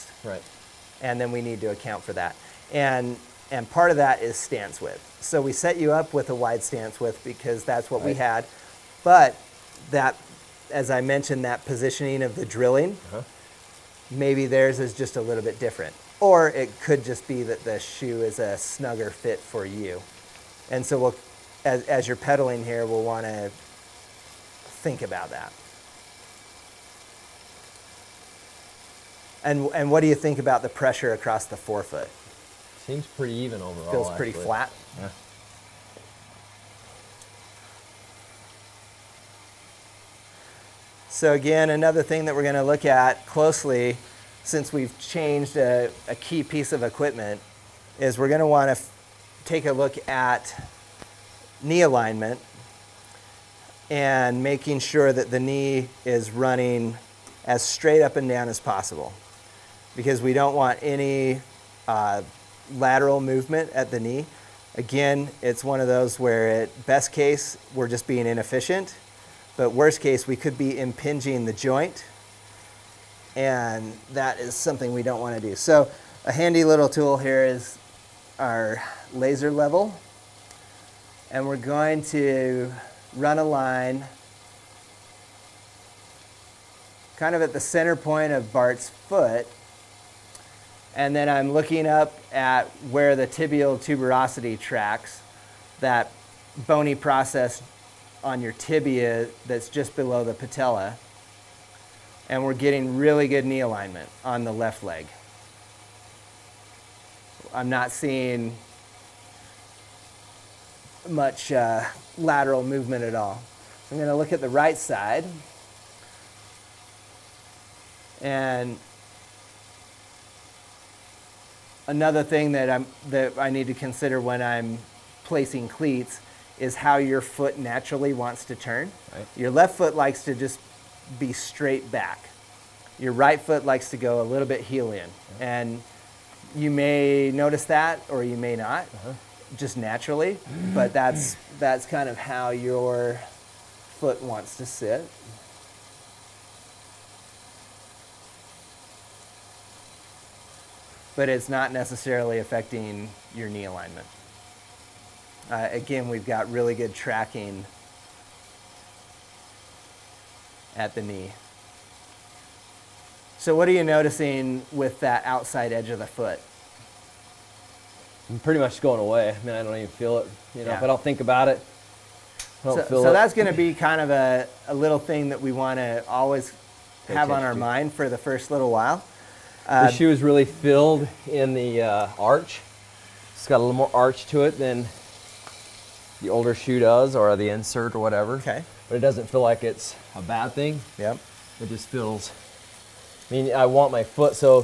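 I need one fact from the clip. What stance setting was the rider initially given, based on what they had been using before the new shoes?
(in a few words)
Wide stance width.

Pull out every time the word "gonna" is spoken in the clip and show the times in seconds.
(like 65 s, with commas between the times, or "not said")
42 s, 48 s.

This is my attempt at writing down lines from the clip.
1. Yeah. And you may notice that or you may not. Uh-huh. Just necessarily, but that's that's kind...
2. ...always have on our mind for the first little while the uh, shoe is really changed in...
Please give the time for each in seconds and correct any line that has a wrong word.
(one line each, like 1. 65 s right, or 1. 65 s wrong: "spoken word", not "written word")
1. 135 s wrong: "naturally", not "necessarily"
2. 176 s wrong: "filled", not "changed".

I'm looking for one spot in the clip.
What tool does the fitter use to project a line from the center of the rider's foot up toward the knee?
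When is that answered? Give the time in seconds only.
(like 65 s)
79 s.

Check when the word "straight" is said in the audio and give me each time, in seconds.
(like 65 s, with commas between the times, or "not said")
57 s, 131 s.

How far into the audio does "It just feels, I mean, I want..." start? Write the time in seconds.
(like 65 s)
191 s.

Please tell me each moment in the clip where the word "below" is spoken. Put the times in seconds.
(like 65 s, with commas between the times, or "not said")
99 s.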